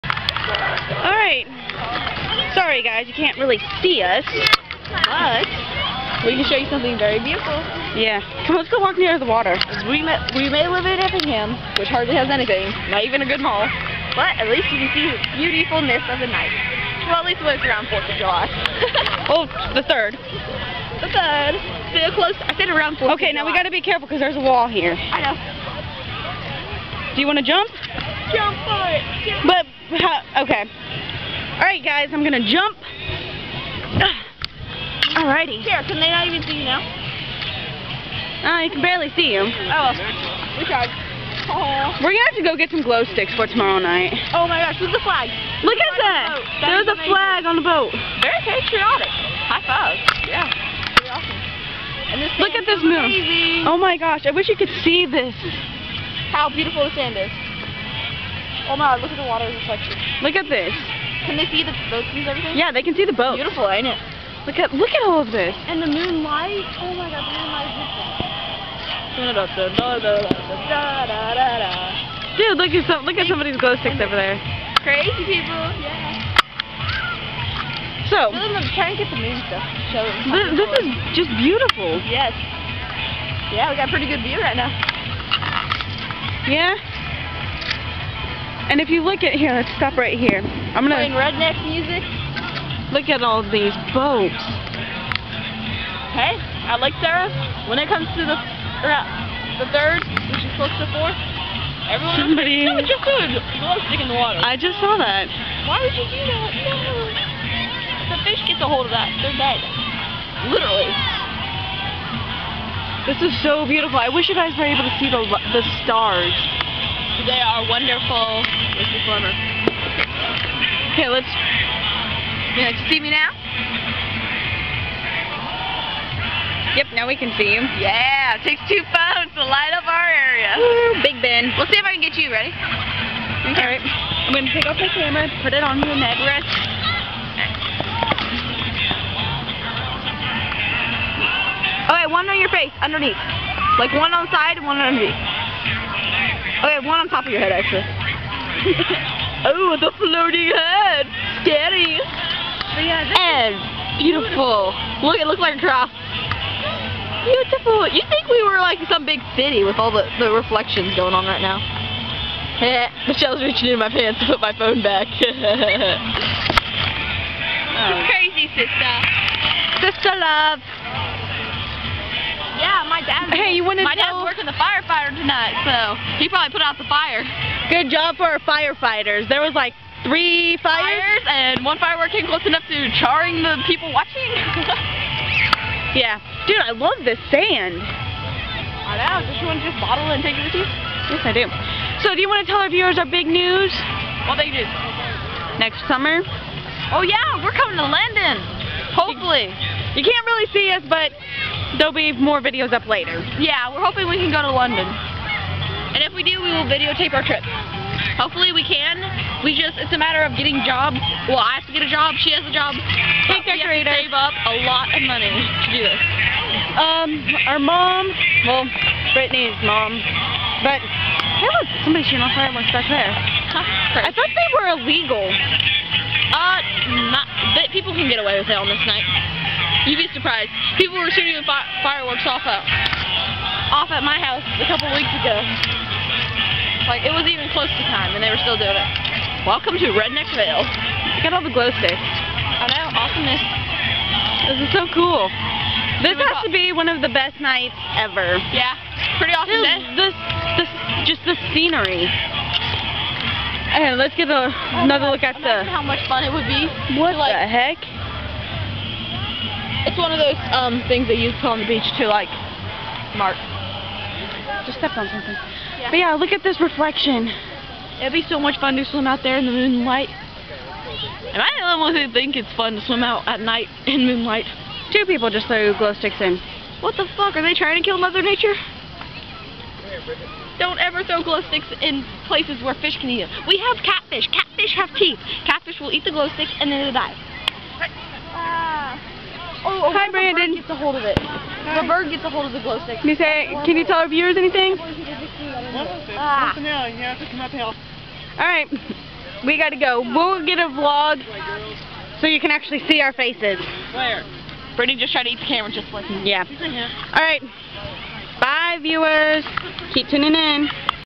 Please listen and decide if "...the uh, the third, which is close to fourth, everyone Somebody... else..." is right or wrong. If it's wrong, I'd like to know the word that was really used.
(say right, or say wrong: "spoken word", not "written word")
right.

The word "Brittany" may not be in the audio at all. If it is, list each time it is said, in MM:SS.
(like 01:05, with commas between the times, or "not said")
03:39, 05:04.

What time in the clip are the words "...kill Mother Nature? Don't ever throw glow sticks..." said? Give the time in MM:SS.
04:37.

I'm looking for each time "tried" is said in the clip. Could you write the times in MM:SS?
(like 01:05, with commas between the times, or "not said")
00:40, 05:05.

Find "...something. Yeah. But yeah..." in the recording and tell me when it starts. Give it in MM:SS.
04:25.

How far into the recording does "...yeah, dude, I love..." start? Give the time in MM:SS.
03:05.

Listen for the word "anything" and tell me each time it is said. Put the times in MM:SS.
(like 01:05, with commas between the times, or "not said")
00:12, 04:54.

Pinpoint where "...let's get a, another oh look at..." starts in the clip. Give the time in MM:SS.
04:13.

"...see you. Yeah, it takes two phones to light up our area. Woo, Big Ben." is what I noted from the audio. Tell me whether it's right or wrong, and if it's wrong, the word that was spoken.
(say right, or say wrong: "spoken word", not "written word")
right.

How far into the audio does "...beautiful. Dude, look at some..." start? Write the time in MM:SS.
01:09.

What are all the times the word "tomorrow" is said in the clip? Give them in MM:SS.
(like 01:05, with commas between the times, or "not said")
00:43.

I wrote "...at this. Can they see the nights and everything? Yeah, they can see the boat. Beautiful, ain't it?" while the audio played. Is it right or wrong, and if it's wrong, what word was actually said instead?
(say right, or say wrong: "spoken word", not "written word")
wrong: "boats", not "nights".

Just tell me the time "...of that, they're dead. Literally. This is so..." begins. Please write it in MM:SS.
01:48.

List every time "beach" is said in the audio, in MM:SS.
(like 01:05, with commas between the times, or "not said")
04:21.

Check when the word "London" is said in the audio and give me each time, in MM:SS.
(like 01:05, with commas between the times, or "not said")
03:17, 03:24.